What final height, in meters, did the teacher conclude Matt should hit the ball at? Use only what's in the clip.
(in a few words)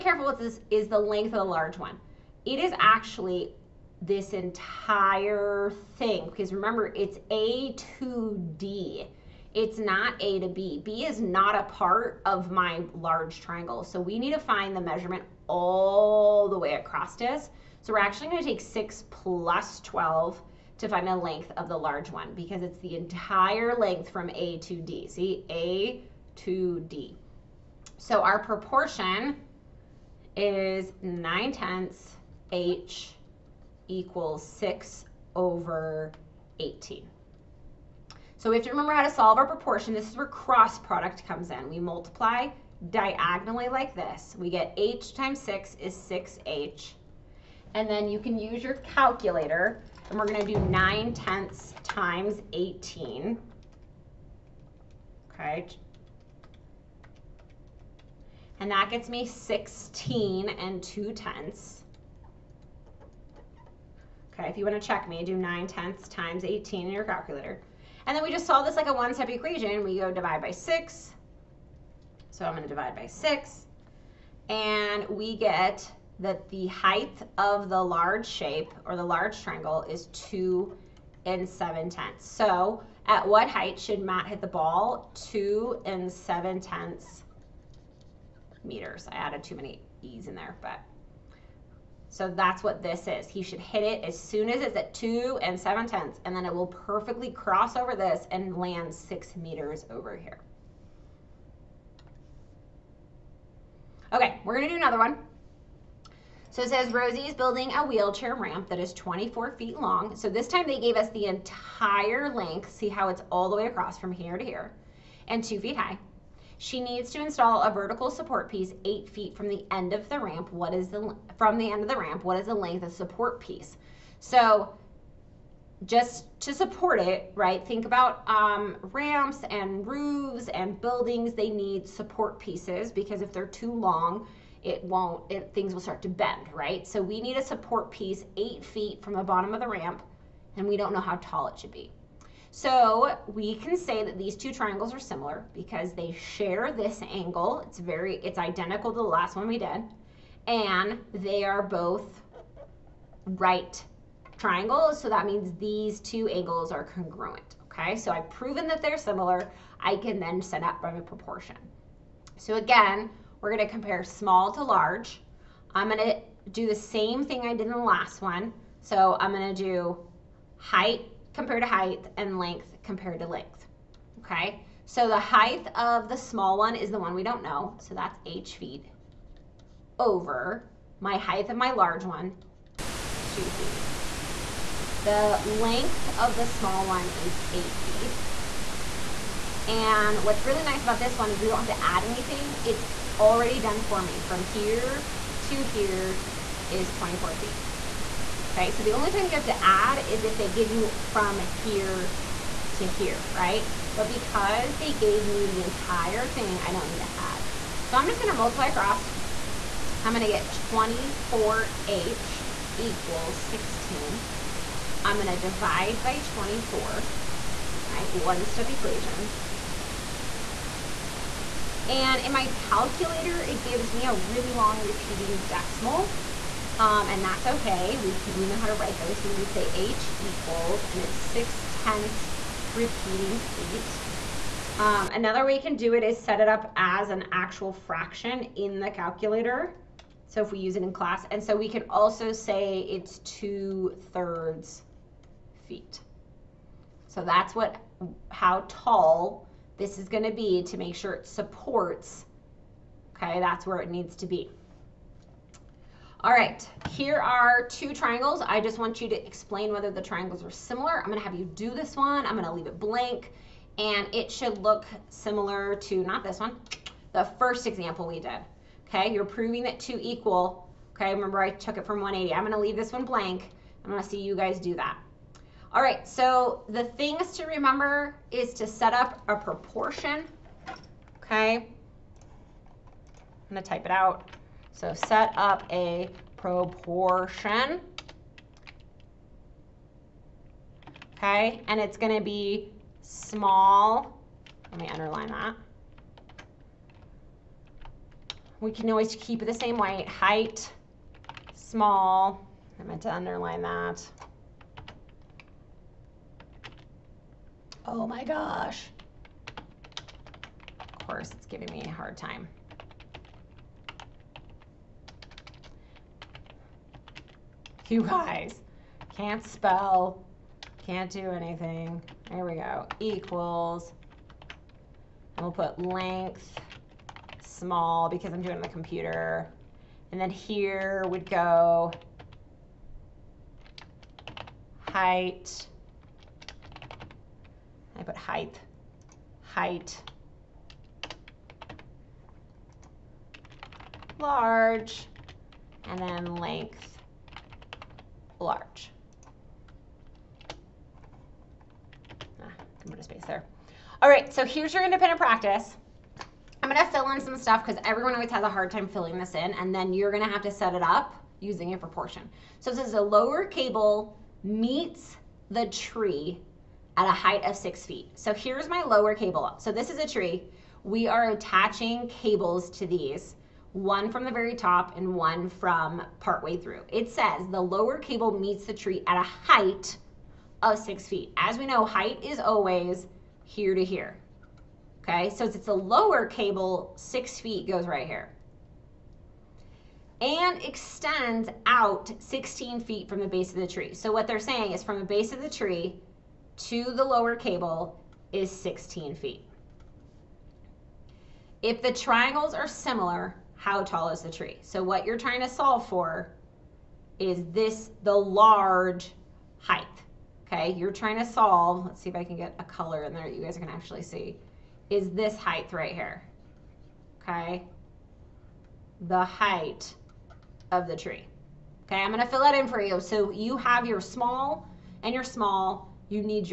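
2.7 meters.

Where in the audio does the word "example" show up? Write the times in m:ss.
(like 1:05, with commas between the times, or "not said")
4:27.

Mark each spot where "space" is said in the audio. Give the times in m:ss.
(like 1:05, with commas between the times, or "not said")
5:53.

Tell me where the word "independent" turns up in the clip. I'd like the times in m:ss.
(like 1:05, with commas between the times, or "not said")
5:54.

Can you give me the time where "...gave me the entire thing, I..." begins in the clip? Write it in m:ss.
3:24.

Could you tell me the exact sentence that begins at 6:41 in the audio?
If the triangles are similar, how tall is the tree?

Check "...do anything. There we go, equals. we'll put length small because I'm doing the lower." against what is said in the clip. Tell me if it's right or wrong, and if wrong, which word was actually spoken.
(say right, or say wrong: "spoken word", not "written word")
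wrong: "computer", not "lower".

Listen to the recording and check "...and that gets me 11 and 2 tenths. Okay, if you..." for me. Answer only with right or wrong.
wrong.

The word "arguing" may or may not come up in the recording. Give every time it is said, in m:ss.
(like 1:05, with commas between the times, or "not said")
not said.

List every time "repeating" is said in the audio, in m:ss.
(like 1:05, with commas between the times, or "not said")
3:44, 3:52.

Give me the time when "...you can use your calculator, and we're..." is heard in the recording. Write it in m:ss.
0:48.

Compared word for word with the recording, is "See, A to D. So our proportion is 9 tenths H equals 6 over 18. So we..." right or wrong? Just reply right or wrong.
right.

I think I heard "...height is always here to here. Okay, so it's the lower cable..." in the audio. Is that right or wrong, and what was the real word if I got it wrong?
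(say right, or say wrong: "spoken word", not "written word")
right.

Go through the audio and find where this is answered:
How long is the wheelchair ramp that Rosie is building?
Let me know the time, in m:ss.
1:48.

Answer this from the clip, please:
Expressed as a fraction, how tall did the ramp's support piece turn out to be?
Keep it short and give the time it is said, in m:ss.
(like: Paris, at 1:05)
two thirds feet, at 4:03.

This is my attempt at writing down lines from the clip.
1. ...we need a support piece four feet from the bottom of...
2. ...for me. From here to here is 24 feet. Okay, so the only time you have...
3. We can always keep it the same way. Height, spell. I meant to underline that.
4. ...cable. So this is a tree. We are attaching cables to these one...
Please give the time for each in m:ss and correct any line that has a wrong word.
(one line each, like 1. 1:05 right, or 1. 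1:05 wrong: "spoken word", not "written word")
1. 2:17 wrong: "eight", not "four"
2. 3:13 right
3. 4:58 wrong: "small", not "spell"
4. 6:09 right.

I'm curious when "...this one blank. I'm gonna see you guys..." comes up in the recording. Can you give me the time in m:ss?
4:32.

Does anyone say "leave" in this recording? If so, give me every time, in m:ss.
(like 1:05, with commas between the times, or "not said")
4:22, 4:32.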